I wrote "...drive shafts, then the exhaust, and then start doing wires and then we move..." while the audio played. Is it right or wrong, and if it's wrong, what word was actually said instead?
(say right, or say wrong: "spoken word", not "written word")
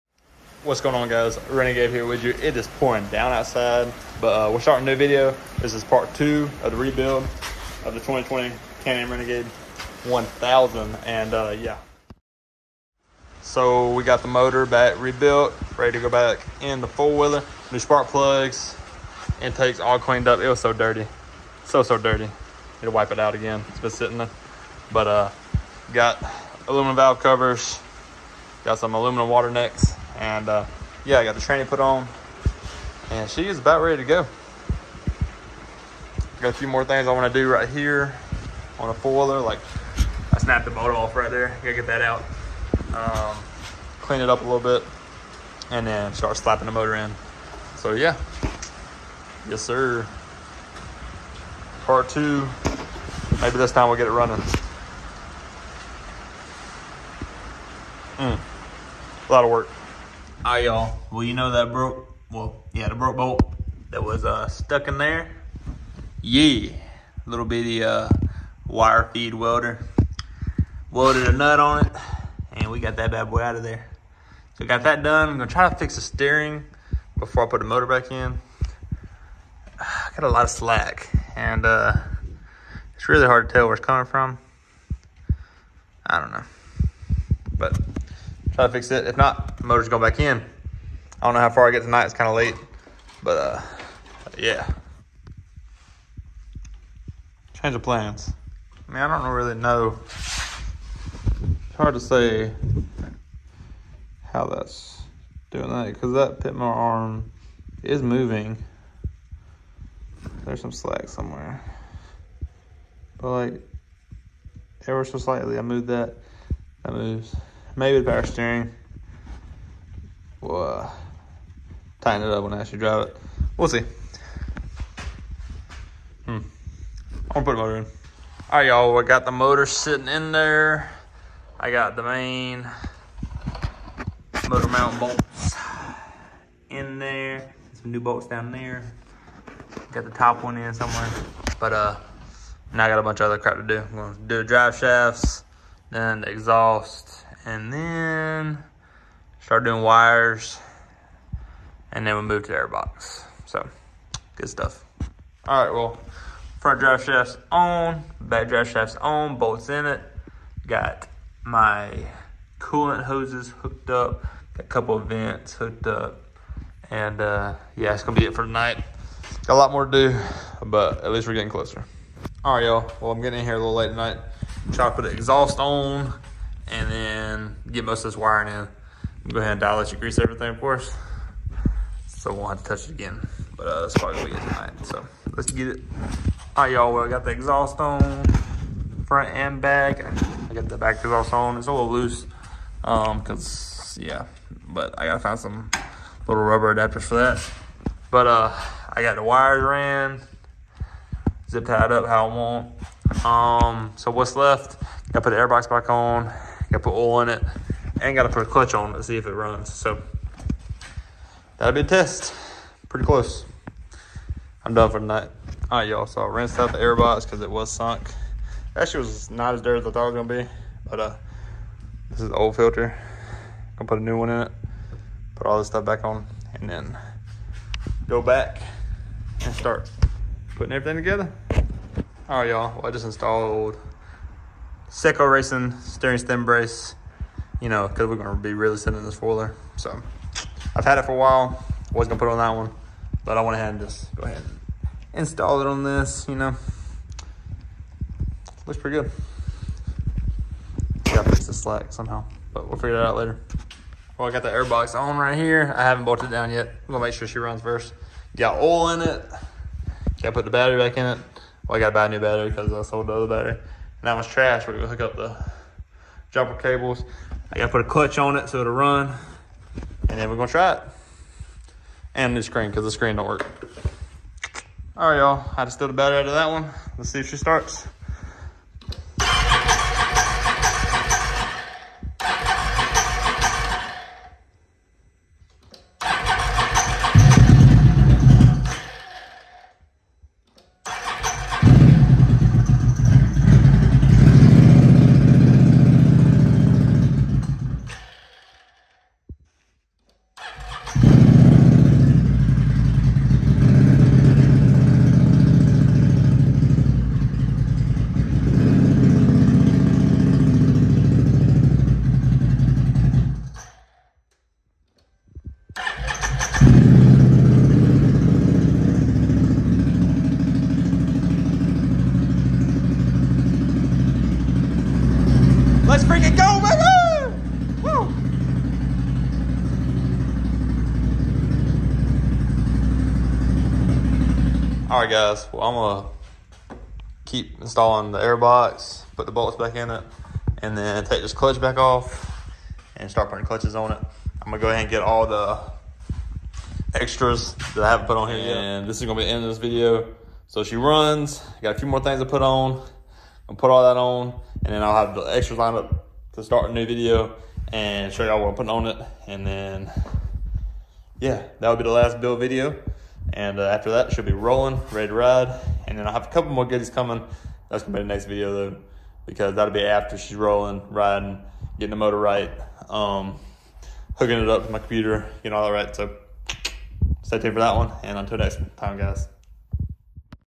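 right.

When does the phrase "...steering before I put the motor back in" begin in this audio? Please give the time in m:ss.
1:16.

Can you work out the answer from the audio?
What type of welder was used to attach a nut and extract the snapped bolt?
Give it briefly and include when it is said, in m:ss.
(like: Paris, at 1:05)
Wire feed welder, at 1:08.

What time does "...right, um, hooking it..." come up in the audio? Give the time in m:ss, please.
6:12.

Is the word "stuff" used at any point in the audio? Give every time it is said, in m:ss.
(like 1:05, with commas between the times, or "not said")
2:34, 3:45.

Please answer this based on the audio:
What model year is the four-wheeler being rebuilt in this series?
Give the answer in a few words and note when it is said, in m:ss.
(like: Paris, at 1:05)
2020, at 0:07.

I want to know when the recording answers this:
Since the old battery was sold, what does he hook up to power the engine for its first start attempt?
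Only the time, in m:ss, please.
4:26.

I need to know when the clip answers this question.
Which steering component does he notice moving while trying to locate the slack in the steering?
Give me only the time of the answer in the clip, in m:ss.
1:46.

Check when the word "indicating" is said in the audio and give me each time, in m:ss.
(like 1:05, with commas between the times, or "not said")
not said.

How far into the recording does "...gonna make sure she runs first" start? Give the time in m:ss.
4:16.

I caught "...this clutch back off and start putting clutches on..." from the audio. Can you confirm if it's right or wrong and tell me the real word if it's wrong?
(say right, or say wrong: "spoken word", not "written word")
right.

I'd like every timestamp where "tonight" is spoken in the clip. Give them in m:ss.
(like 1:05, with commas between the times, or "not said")
1:31, 2:48, 2:53, 3:04, 3:34.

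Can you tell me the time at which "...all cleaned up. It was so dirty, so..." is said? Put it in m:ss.
0:19.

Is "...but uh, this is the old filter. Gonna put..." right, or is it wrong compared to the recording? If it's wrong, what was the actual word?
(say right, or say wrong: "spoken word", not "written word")
right.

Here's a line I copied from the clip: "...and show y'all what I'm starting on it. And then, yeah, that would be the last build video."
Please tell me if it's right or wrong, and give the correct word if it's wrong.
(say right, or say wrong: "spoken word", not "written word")
wrong: "putting", not "starting".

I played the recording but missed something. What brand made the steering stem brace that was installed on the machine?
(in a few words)
Seco Racing.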